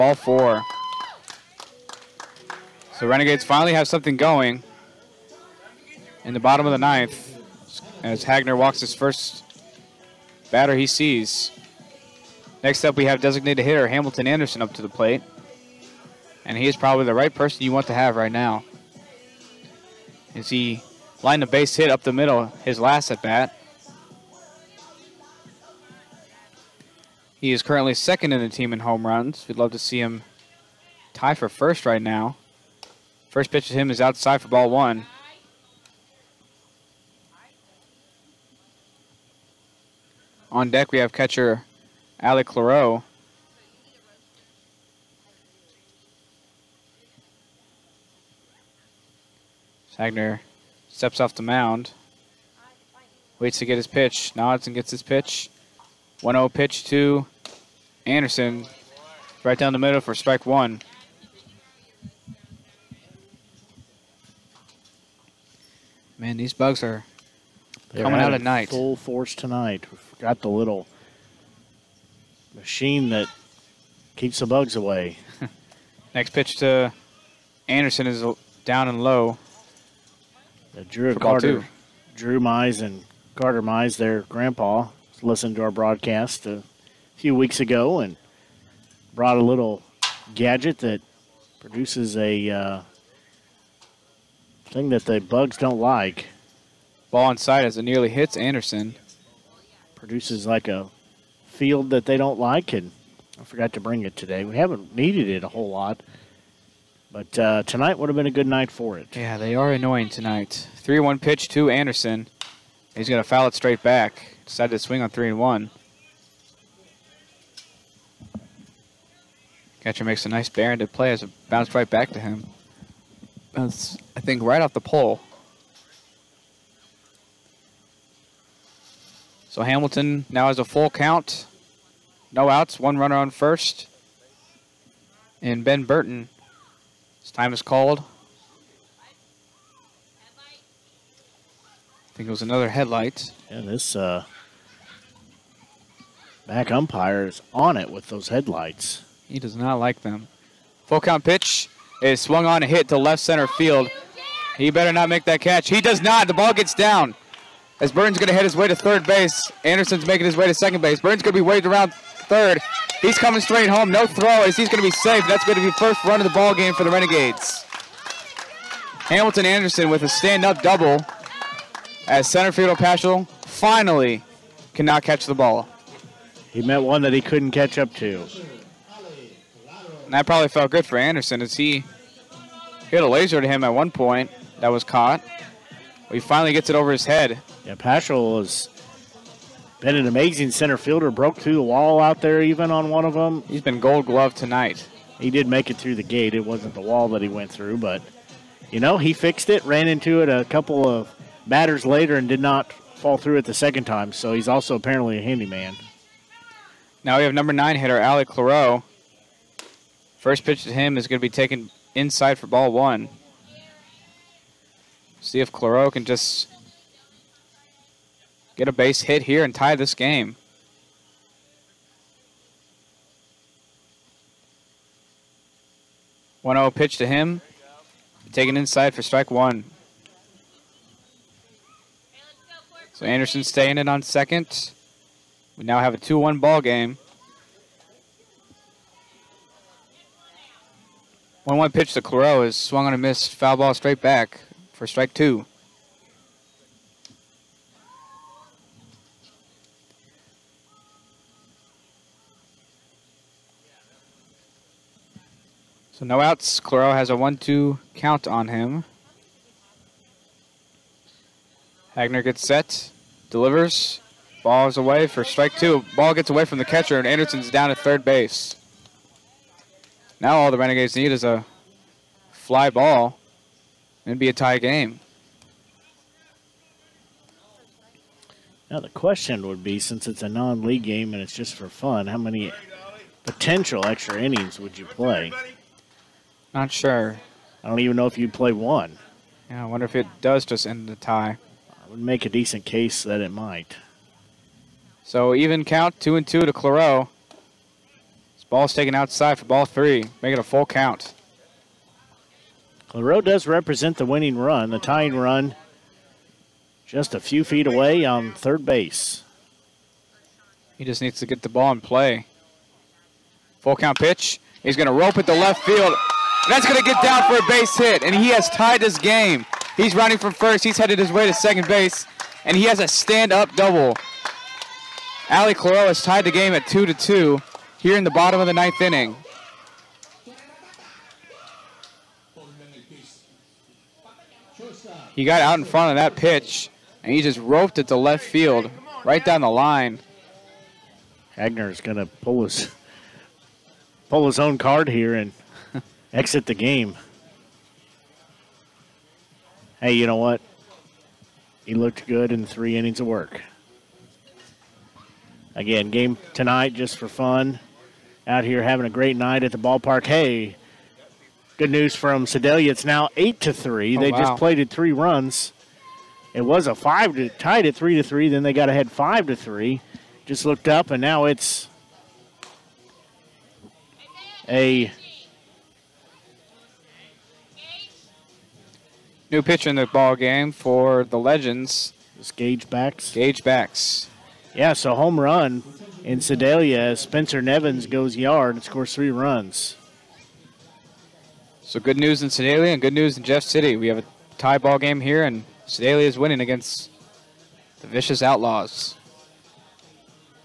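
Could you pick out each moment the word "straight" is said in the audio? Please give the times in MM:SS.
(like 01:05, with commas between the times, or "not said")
01:53, 02:43, 04:03.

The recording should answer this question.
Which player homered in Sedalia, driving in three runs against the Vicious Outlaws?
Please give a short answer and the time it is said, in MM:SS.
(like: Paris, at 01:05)
Spencer Nevins, at 06:26.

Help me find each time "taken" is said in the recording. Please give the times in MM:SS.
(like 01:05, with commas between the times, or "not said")
03:31, 03:48, 04:58.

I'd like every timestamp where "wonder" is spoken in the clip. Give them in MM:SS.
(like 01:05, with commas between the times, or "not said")
04:49.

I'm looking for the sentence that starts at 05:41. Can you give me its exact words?
Hagner is going to pull his pull his own card here and – exit the game.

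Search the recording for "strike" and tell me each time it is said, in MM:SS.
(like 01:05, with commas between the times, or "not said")
01:00, 03:49, 04:04, 04:25.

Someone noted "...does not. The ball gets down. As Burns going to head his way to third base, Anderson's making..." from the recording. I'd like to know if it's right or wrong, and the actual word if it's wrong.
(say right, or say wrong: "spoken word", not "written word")
right.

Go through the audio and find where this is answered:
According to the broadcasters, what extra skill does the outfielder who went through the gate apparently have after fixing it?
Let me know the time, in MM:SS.
03:25.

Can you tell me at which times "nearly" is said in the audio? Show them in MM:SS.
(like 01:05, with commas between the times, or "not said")
01:37.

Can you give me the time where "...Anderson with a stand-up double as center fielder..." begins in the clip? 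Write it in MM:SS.
02:49.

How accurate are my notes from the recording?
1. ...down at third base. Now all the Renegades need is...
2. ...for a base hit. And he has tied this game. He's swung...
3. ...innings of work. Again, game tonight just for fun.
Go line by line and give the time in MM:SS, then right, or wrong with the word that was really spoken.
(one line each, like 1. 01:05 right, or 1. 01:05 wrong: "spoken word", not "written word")
1. 04:27 right
2. 05:17 wrong: "running", not "swung"
3. 05:52 right.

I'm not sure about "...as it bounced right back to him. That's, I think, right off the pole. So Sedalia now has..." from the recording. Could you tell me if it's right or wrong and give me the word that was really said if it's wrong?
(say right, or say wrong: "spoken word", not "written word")
wrong: "Hamilton", not "Sedalia".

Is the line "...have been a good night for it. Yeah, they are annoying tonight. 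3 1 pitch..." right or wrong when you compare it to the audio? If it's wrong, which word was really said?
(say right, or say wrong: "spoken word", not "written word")
right.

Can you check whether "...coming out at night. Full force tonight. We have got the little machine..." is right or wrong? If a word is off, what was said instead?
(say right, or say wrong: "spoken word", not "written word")
right.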